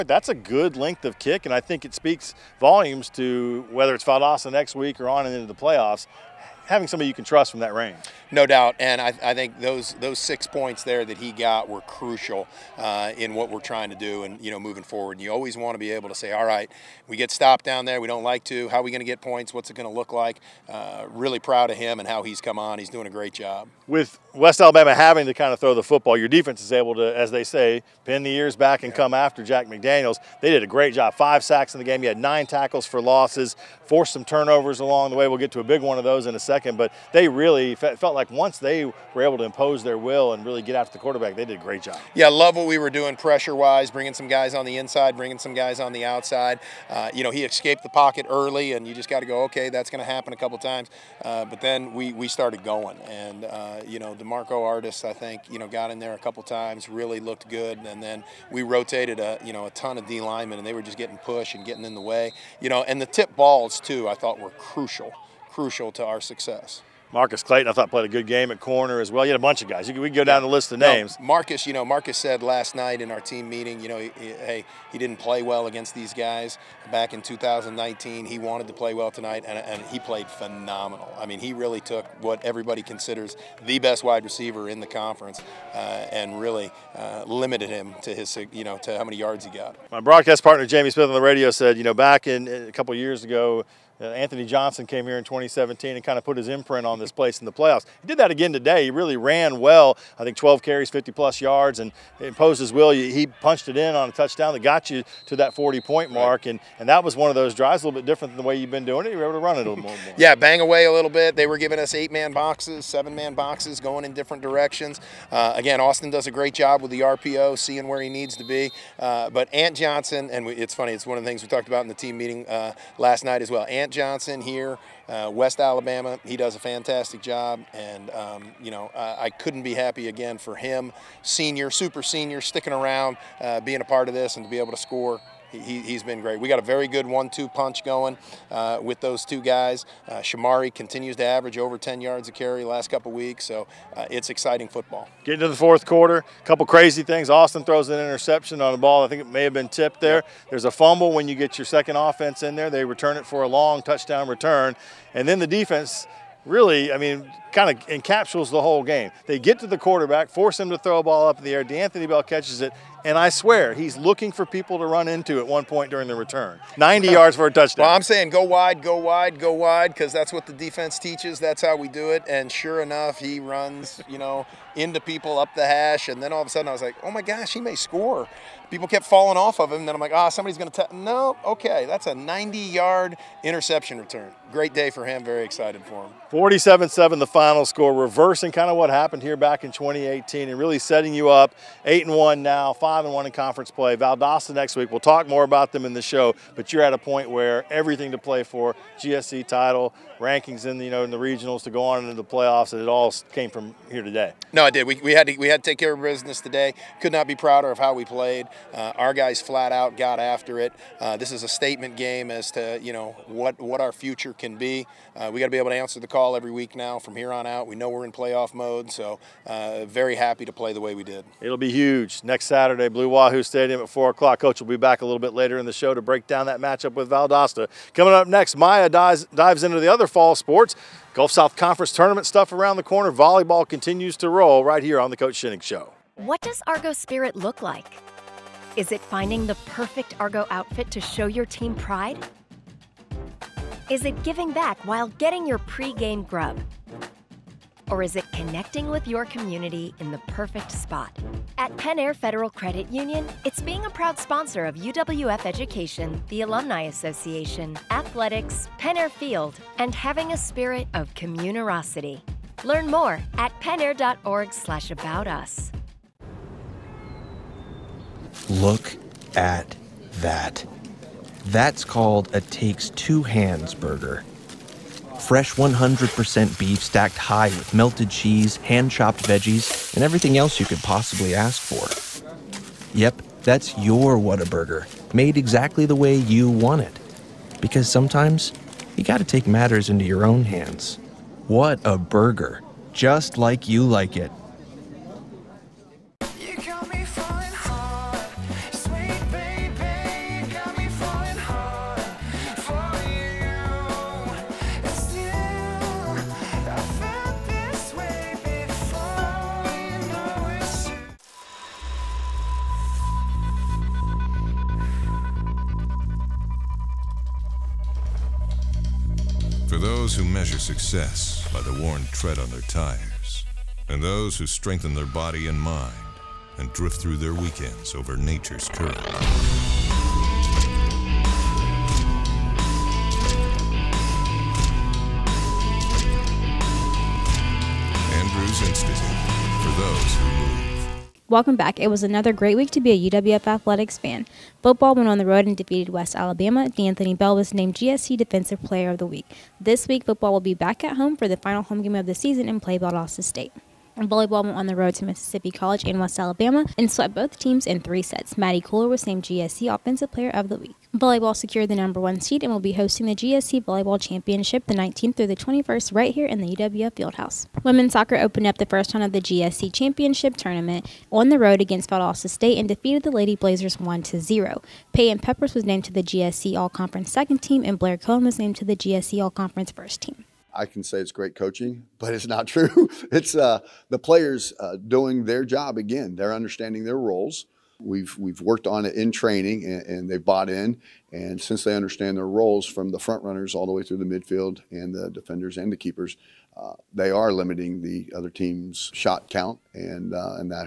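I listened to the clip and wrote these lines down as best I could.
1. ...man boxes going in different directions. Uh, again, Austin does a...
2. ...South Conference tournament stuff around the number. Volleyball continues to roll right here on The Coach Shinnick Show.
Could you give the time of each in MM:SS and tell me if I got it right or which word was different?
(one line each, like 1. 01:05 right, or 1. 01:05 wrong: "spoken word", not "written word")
1. 01:53 right
2. 03:51 wrong: "corner", not "number".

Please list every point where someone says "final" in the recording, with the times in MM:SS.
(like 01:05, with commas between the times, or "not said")
03:07, 05:51.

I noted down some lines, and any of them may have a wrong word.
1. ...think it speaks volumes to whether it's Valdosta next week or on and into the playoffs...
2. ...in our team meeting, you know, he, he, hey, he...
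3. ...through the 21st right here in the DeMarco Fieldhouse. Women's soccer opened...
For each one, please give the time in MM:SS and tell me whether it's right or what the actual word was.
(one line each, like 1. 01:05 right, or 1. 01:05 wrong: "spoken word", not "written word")
1. 00:01 right
2. 01:13 right
3. 06:05 wrong: "UWF", not "DeMarco".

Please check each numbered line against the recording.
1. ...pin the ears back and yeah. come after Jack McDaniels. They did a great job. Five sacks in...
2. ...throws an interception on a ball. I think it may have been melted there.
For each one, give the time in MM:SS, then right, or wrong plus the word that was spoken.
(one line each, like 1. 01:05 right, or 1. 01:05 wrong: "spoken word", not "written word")
1. 00:28 right
2. 02:27 wrong: "tipped", not "melted".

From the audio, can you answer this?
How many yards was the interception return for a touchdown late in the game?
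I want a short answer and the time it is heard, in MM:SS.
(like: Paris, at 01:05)
90, at 02:46.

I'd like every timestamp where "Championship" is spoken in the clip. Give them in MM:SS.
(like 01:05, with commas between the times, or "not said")
06:03, 06:09.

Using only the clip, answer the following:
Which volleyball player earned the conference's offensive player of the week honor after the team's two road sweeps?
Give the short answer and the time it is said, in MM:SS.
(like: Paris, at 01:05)
Maddie Cooler, at 05:58.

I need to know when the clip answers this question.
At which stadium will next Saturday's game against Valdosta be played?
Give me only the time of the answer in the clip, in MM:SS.
03:42.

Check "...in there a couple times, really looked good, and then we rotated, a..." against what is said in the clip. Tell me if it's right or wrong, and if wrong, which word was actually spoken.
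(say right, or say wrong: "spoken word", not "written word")
right.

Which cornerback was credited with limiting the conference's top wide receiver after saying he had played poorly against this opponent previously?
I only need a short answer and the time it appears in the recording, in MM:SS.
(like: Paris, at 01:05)
Marcus Clayton, at 01:07.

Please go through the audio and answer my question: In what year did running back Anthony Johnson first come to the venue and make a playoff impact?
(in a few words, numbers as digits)
2017.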